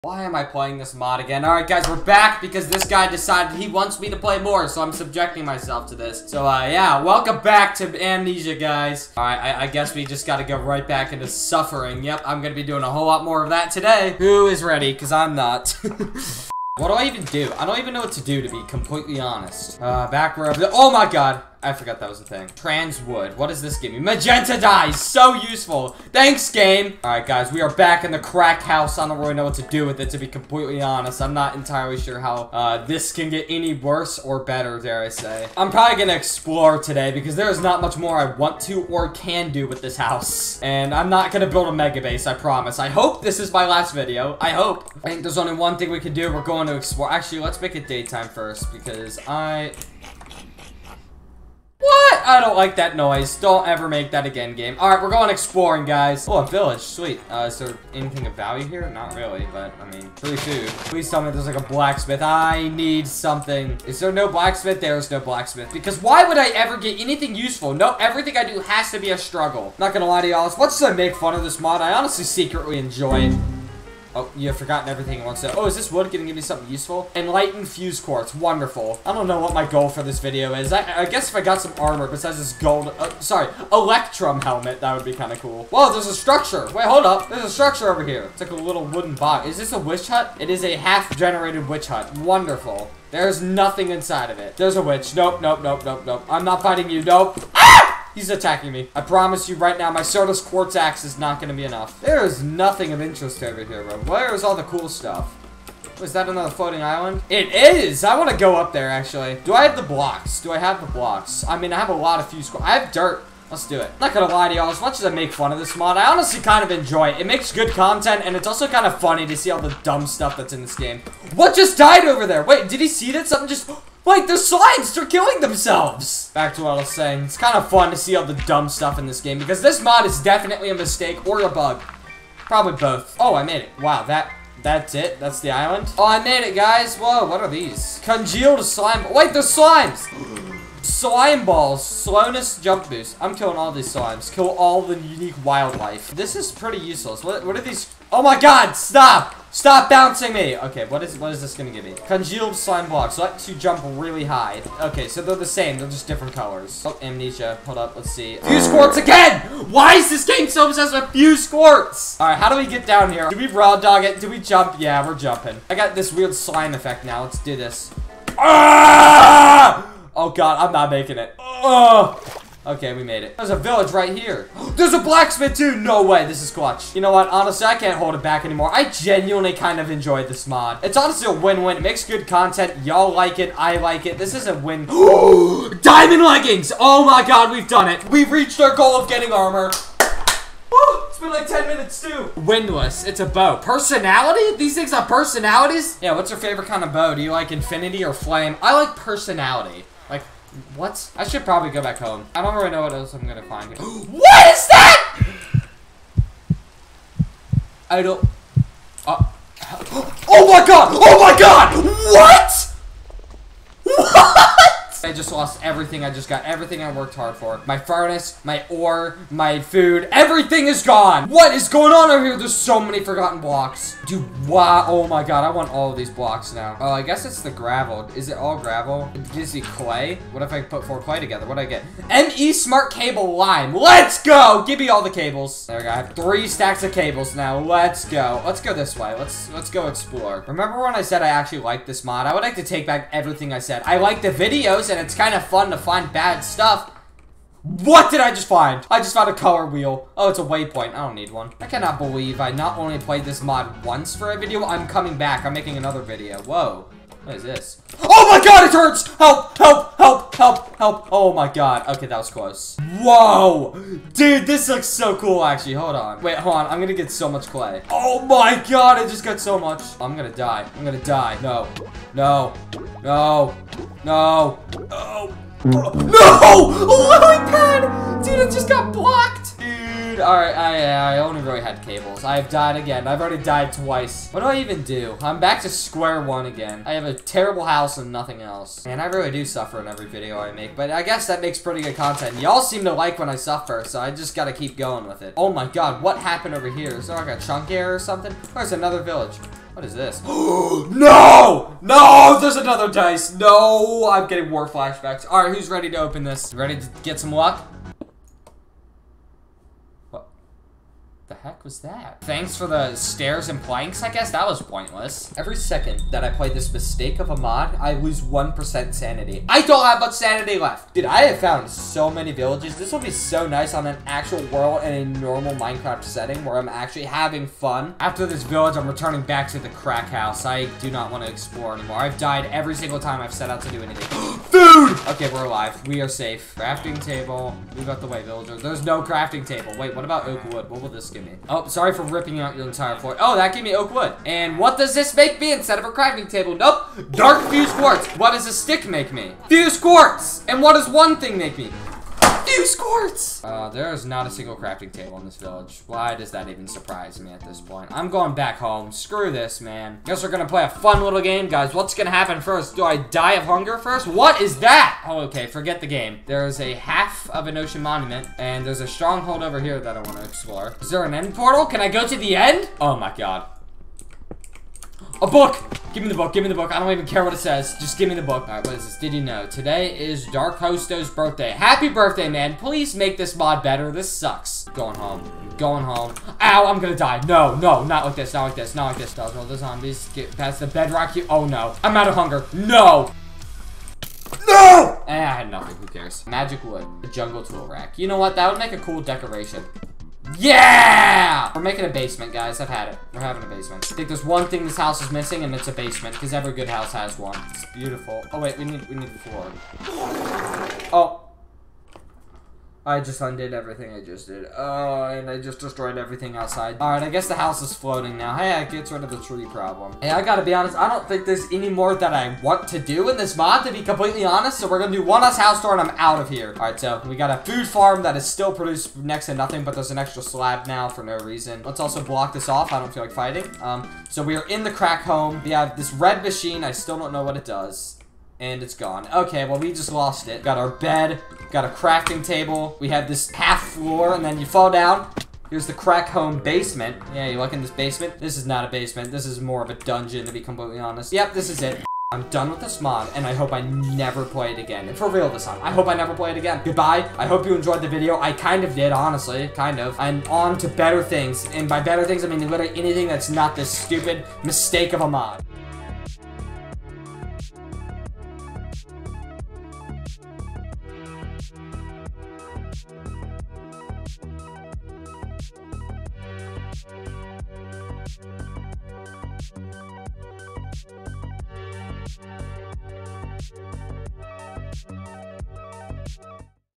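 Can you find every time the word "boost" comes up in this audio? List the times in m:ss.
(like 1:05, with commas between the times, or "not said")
2:22.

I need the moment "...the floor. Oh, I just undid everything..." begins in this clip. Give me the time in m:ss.
6:49.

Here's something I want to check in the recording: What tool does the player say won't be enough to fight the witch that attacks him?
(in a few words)
Certus Quartz Axe.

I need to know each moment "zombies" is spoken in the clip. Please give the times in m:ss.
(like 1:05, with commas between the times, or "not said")
6:29.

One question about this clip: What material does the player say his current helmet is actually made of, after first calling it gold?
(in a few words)
Electrum.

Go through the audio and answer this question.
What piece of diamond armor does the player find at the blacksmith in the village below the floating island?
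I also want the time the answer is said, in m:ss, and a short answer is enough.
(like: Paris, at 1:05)
Diamond leggings, at 3:04.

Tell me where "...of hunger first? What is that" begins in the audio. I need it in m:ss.
6:03.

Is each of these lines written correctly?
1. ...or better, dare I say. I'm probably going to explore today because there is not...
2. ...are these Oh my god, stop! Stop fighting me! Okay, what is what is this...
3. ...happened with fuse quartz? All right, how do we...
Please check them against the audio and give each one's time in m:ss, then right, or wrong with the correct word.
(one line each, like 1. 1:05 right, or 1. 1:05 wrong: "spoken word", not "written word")
1. 0:34 right
2. 2:27 wrong: "bouncing", not "fighting"
3. 2:40 wrong: "obsessed", not "happened".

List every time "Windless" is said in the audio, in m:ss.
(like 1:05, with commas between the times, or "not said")
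3:12.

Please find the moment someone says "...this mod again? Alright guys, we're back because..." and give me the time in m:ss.
0:00.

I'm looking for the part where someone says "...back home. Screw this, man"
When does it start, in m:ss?
5:58.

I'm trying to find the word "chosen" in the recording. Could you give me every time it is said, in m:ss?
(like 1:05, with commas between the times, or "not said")
not said.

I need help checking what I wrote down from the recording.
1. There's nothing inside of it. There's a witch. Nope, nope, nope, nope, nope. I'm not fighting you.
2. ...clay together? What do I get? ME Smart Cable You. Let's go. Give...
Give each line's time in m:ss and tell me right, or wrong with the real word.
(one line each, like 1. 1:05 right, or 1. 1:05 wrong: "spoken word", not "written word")
1. 1:33 right
2. 3:51 wrong: "Lime", not "You".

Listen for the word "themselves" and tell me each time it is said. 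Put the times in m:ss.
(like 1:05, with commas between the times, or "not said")
2:05.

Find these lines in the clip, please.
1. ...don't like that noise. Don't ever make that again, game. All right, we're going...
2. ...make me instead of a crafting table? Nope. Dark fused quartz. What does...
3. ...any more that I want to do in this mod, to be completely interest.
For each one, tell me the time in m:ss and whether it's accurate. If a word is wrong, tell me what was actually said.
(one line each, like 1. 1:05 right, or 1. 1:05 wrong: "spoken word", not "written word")
1. 0:52 right
2. 5:45 right
3. 7:01 wrong: "honest", not "interest".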